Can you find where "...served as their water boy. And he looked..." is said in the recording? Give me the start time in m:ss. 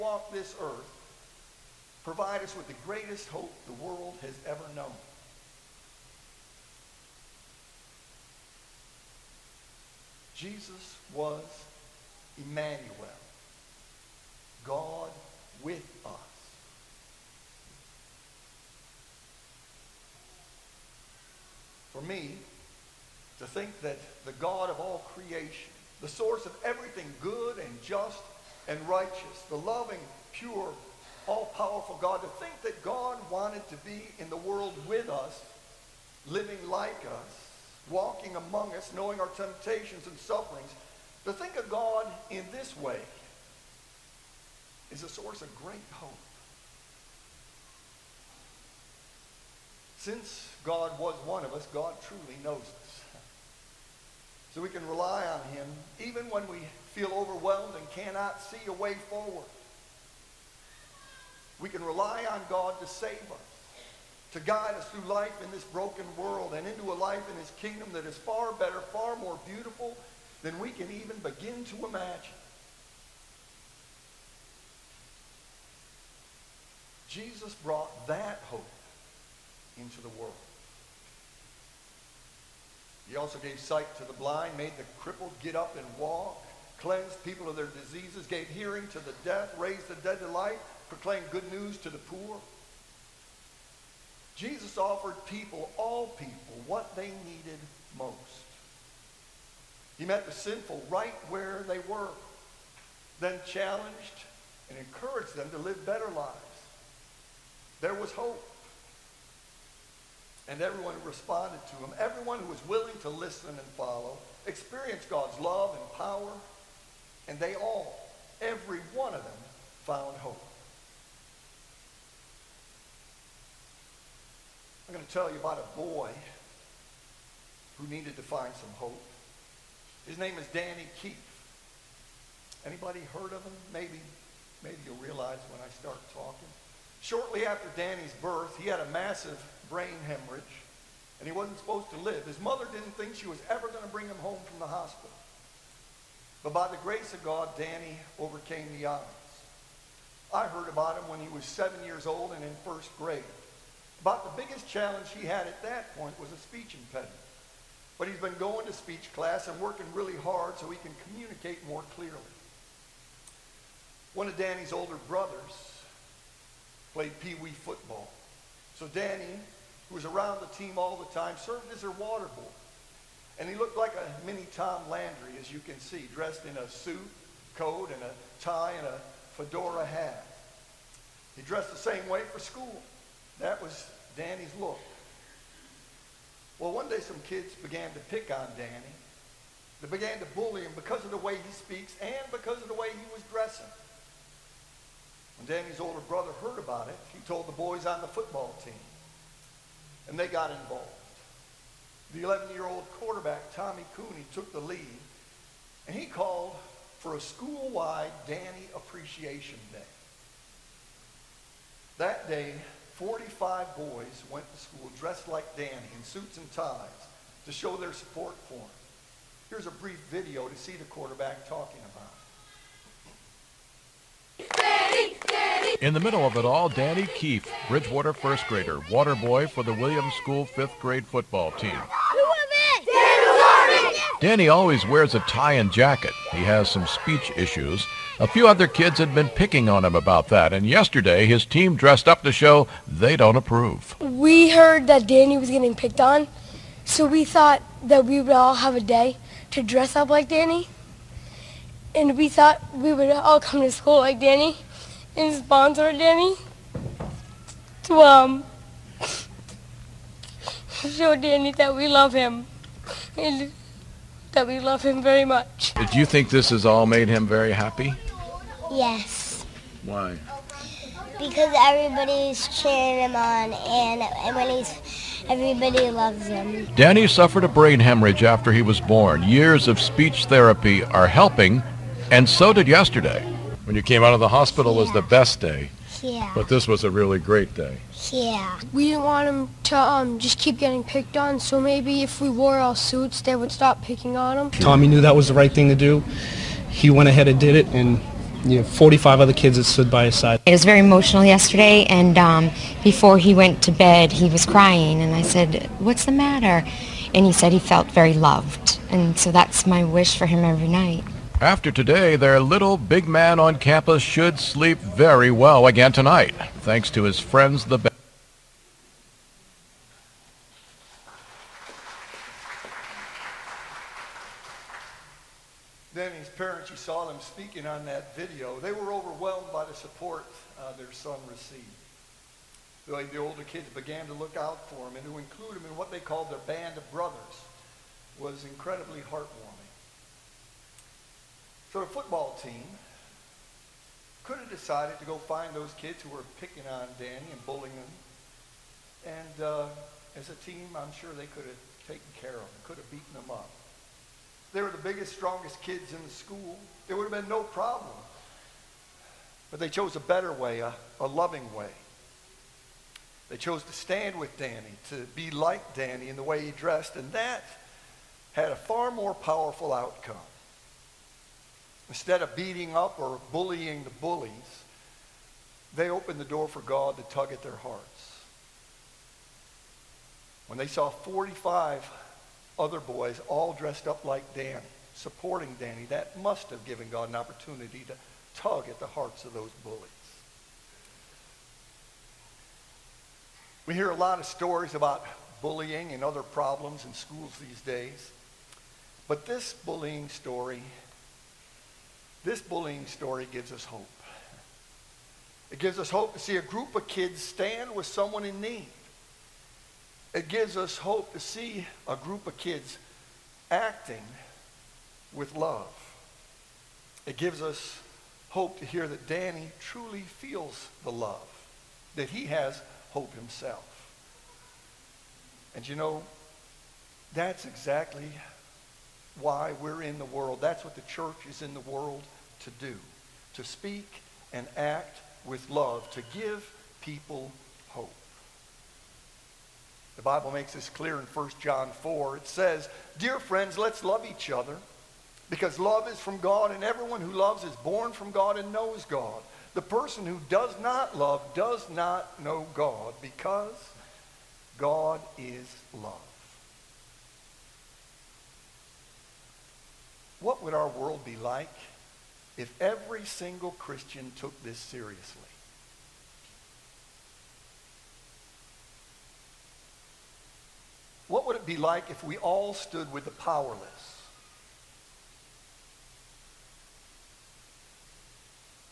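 2:51.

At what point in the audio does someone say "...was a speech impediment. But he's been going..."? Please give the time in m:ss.
2:36.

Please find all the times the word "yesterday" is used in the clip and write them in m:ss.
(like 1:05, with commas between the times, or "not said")
4:00, 4:42, 5:01.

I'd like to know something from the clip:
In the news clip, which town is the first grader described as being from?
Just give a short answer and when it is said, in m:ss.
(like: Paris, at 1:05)
Bridgewater, at 3:47.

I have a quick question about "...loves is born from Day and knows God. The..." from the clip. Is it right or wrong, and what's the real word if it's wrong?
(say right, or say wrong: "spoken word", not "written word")
wrong: "God", not "Day".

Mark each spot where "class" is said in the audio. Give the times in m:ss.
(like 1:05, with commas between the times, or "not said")
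2:39.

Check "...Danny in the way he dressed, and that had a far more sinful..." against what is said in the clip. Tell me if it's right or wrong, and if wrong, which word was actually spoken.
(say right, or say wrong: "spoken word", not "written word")
wrong: "powerful", not "sinful".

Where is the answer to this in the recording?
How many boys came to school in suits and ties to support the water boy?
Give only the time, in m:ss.
3:32.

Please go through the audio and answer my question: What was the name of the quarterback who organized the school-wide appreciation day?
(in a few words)
Tommy Cooney.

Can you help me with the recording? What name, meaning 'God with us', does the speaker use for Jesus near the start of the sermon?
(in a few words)
Emmanuel.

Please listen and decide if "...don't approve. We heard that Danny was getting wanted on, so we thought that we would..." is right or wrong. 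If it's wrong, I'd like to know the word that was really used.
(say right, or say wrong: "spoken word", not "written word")
wrong: "picked", not "wanted".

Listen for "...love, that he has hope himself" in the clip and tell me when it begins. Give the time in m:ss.
7:00.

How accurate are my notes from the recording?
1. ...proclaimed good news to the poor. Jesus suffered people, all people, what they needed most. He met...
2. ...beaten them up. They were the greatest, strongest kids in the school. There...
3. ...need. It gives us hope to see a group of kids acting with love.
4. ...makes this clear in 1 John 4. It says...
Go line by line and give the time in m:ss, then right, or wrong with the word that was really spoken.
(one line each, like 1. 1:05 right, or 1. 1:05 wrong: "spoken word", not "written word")
1. 1:30 wrong: "offered", not "suffered"
2. 5:52 wrong: "biggest", not "greatest"
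3. 6:48 right
4. 7:20 right.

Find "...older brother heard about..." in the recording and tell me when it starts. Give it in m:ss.
3:15.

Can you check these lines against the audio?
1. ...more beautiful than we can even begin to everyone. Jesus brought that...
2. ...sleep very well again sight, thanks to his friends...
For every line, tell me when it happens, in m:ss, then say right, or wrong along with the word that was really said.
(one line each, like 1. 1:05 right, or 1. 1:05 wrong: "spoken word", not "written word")
1. 1:09 wrong: "imagine", not "everyone"
2. 5:14 wrong: "tonight", not "sight".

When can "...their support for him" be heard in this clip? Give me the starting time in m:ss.
3:37.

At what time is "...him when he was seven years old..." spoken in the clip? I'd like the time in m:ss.
2:30.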